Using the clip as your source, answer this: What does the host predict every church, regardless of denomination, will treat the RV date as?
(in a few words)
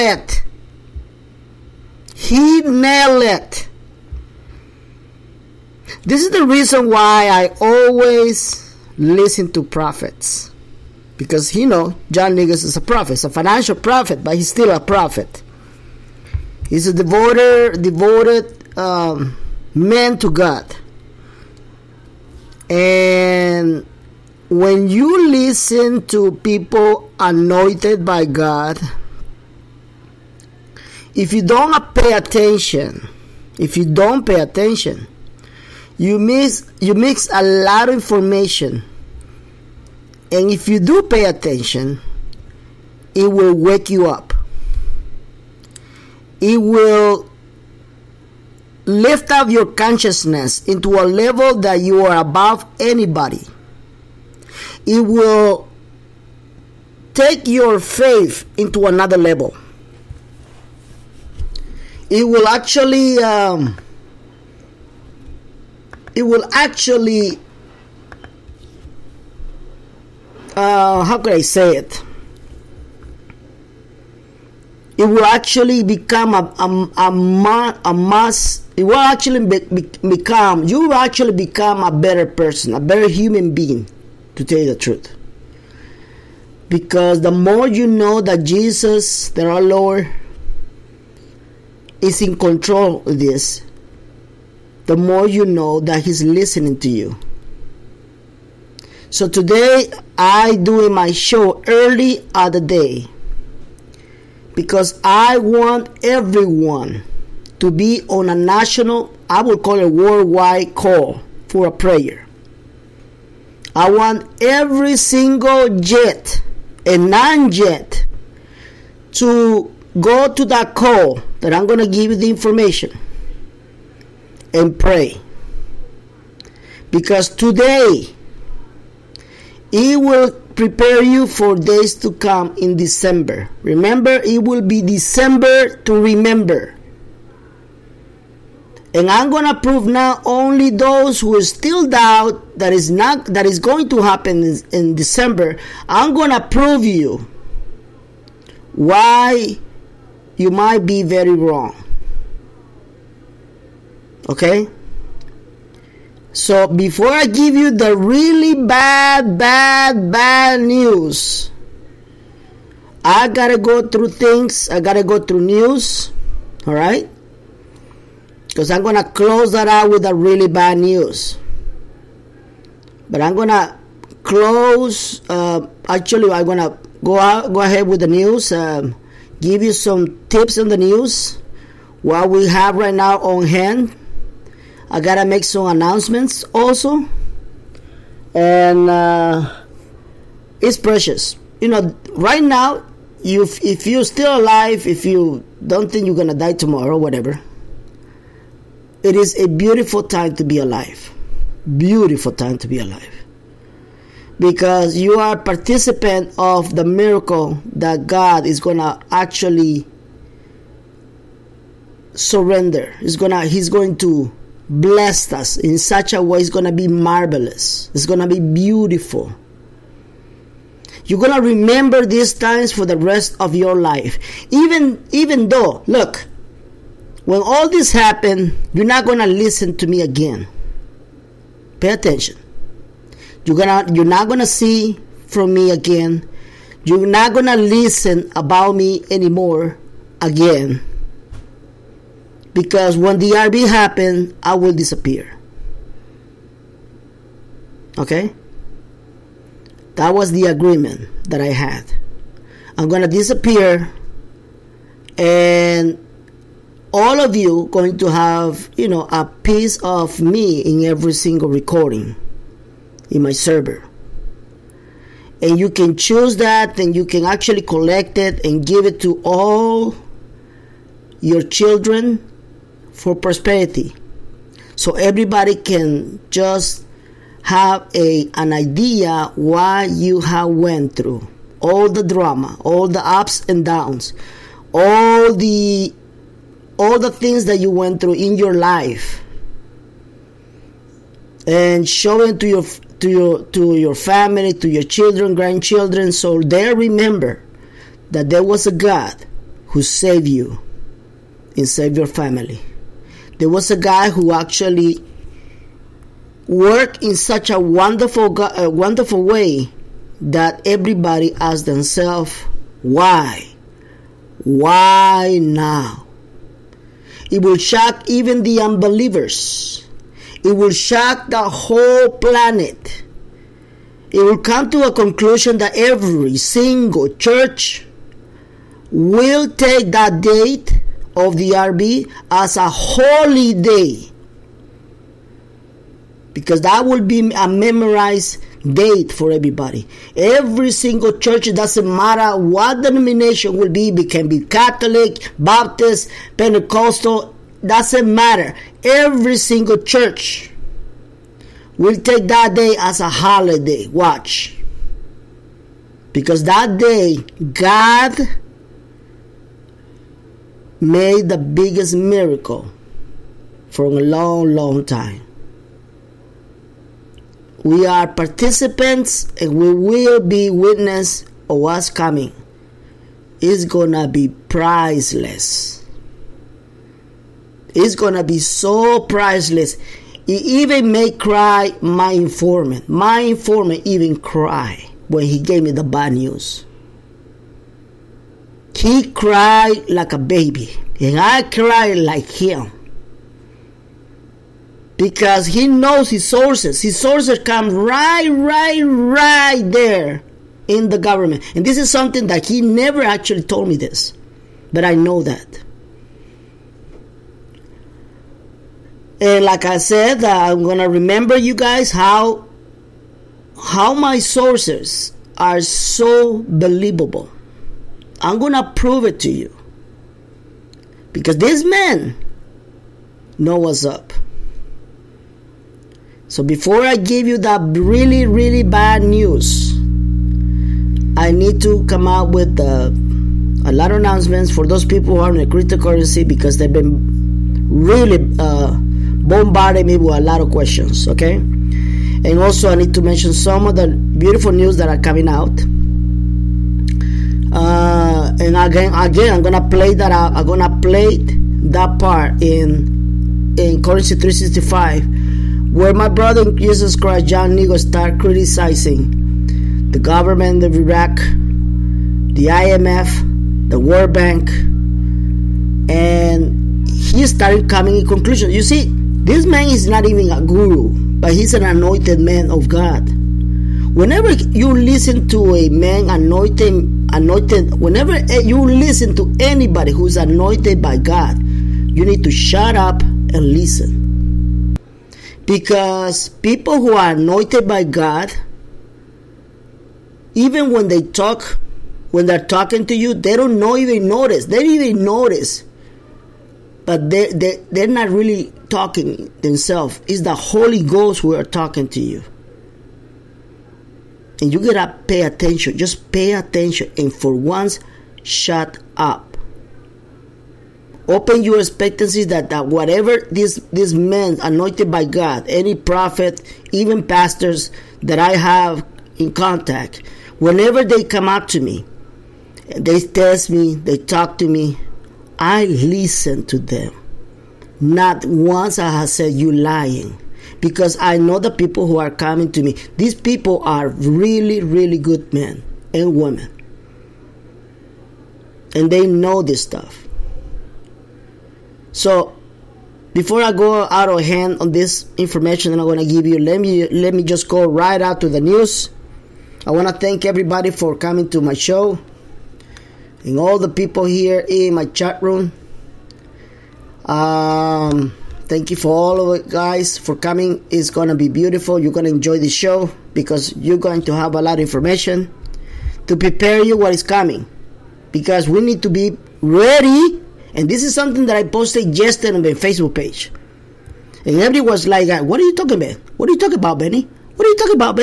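A holy day.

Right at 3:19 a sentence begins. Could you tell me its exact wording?
It is a beautiful time to be alive.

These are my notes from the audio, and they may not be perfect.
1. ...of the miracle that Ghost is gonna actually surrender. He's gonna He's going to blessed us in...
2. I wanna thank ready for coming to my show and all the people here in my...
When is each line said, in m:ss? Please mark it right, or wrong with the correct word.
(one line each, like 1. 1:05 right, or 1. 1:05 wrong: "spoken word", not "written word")
1. 3:26 wrong: "God", not "Ghost"
2. 9:09 wrong: "everybody", not "ready".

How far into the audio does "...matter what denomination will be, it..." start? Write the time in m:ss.
5:41.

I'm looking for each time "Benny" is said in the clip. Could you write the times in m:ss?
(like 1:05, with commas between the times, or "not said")
9:36.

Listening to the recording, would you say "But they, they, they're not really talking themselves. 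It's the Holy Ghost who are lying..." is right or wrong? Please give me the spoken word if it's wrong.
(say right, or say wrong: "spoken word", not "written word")
wrong: "talking", not "lying".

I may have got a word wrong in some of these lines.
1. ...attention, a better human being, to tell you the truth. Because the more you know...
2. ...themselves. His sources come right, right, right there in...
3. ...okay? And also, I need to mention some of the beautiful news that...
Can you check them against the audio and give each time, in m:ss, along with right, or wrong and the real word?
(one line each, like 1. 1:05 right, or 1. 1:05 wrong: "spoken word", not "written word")
1. 1:22 wrong: "person", not "attention"
2. 6:36 wrong: "sources", not "themselves"
3. 7:21 right.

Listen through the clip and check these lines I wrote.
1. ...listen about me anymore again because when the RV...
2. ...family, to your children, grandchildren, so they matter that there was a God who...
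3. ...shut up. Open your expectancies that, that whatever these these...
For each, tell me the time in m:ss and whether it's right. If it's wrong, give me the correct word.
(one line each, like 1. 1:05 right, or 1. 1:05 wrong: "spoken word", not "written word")
1. 3:57 right
2. 4:53 wrong: "remember", not "matter"
3. 8:28 right.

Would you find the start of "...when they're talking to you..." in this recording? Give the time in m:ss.
8:12.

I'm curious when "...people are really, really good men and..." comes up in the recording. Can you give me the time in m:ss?
8:53.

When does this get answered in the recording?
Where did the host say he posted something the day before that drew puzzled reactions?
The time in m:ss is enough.
9:32.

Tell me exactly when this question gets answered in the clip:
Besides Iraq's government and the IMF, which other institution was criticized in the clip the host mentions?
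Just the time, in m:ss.
7:43.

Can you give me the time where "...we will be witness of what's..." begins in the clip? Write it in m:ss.
6:09.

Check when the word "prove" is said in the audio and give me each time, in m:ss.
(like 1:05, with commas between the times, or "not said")
2:19, 2:26, 6:58.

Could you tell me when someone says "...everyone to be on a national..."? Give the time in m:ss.
1:46.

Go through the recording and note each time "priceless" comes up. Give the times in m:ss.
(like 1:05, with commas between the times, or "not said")
6:14, 6:19.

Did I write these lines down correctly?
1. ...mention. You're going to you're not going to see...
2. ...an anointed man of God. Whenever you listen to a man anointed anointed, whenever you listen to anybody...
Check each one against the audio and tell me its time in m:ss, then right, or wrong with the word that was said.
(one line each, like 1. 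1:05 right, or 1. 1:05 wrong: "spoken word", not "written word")
1. 3:51 wrong: "attention", not "mention"
2. 7:51 right.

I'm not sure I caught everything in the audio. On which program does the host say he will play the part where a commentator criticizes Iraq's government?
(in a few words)
Currency 365.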